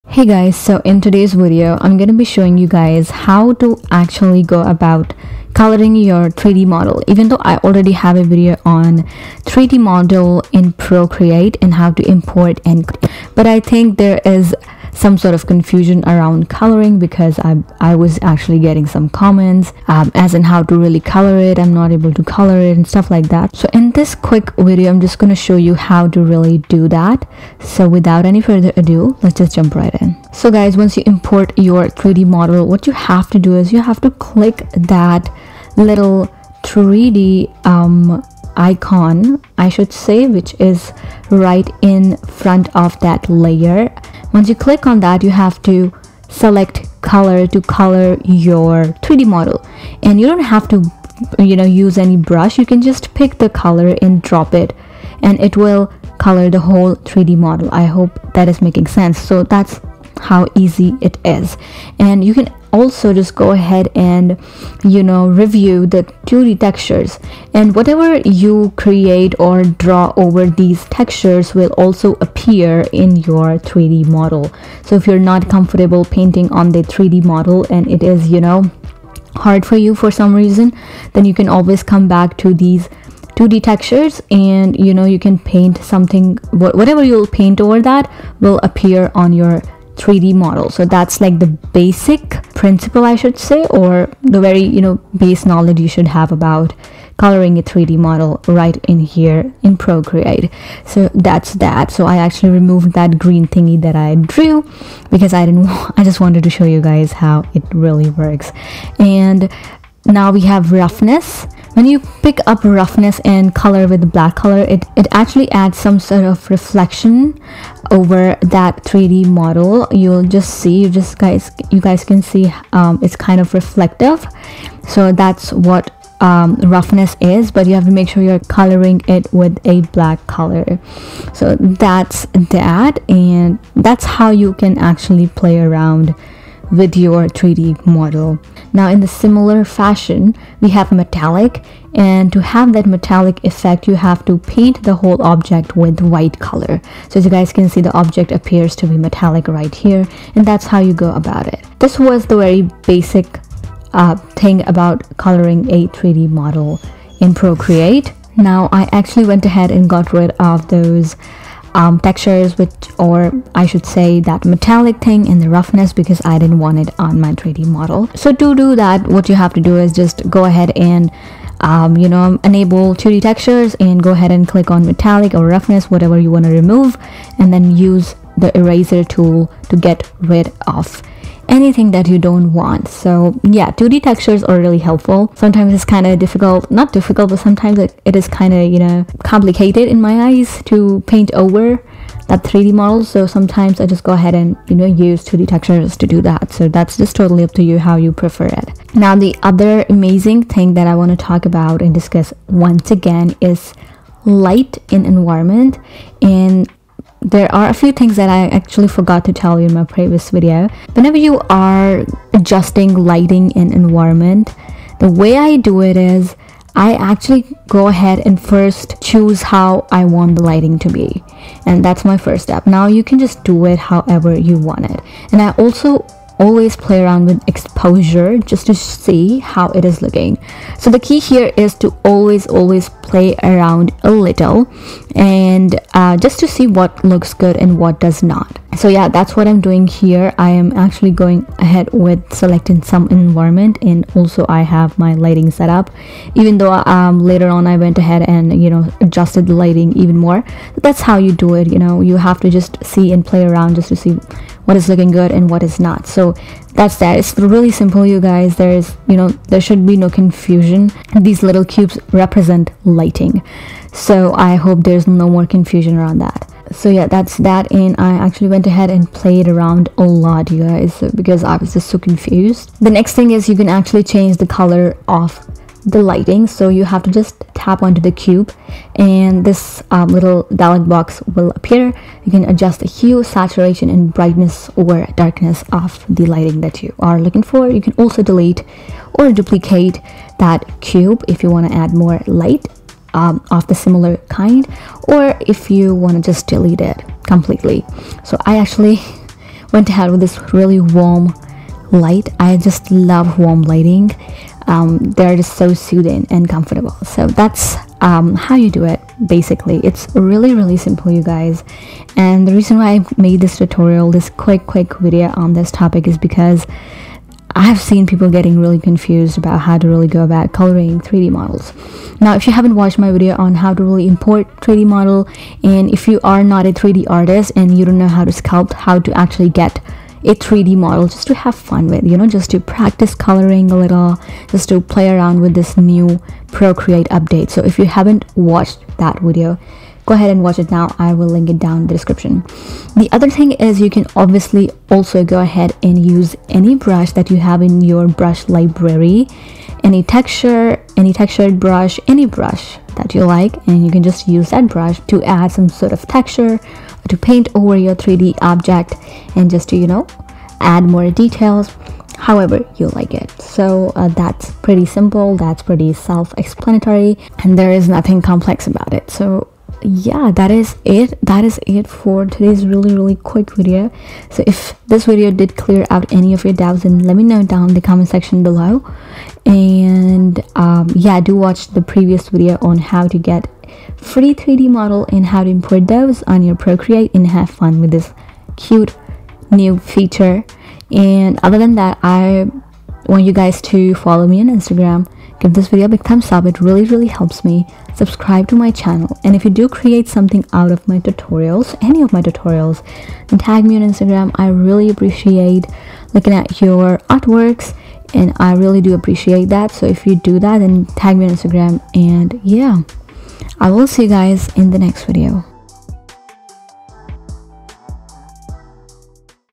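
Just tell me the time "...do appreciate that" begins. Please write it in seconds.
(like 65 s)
408 s.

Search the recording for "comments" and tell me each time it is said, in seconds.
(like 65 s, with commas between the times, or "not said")
19 s, 377 s.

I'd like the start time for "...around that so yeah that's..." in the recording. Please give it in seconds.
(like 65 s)
265 s.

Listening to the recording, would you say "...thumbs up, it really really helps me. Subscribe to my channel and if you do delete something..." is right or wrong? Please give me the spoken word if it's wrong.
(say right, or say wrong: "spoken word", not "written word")
wrong: "create", not "delete".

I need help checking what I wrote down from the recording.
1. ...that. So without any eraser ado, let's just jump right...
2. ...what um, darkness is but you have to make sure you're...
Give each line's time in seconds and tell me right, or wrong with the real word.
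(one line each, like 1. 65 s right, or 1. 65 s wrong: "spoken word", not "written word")
1. 26 s wrong: "further", not "eraser"
2. 125 s wrong: "roughness", not "darkness".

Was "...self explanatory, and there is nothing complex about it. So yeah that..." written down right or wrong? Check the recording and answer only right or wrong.
right.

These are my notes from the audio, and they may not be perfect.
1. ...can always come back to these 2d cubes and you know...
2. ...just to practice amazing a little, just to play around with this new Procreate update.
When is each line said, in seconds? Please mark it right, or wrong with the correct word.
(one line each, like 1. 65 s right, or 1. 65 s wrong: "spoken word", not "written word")
1. 81 s wrong: "textures", not "cubes"
2. 332 s wrong: "coloring", not "amazing".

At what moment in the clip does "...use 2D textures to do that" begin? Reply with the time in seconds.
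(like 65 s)
194 s.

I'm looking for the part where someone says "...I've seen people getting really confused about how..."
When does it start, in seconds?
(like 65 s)
317 s.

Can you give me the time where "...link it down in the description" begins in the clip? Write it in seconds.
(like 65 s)
341 s.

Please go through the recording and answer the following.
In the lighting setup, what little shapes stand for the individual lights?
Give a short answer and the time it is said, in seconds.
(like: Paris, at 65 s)
Cubes, at 261 s.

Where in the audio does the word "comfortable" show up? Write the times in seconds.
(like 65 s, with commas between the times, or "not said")
75 s, 306 s.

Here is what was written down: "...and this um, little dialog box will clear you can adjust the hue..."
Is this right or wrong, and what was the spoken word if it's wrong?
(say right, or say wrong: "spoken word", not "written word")
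wrong: "appear", not "clear".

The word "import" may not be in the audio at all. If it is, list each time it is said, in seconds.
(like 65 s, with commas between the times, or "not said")
12 s, 31 s, 324 s, 385 s.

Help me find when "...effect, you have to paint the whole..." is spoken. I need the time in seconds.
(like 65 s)
143 s.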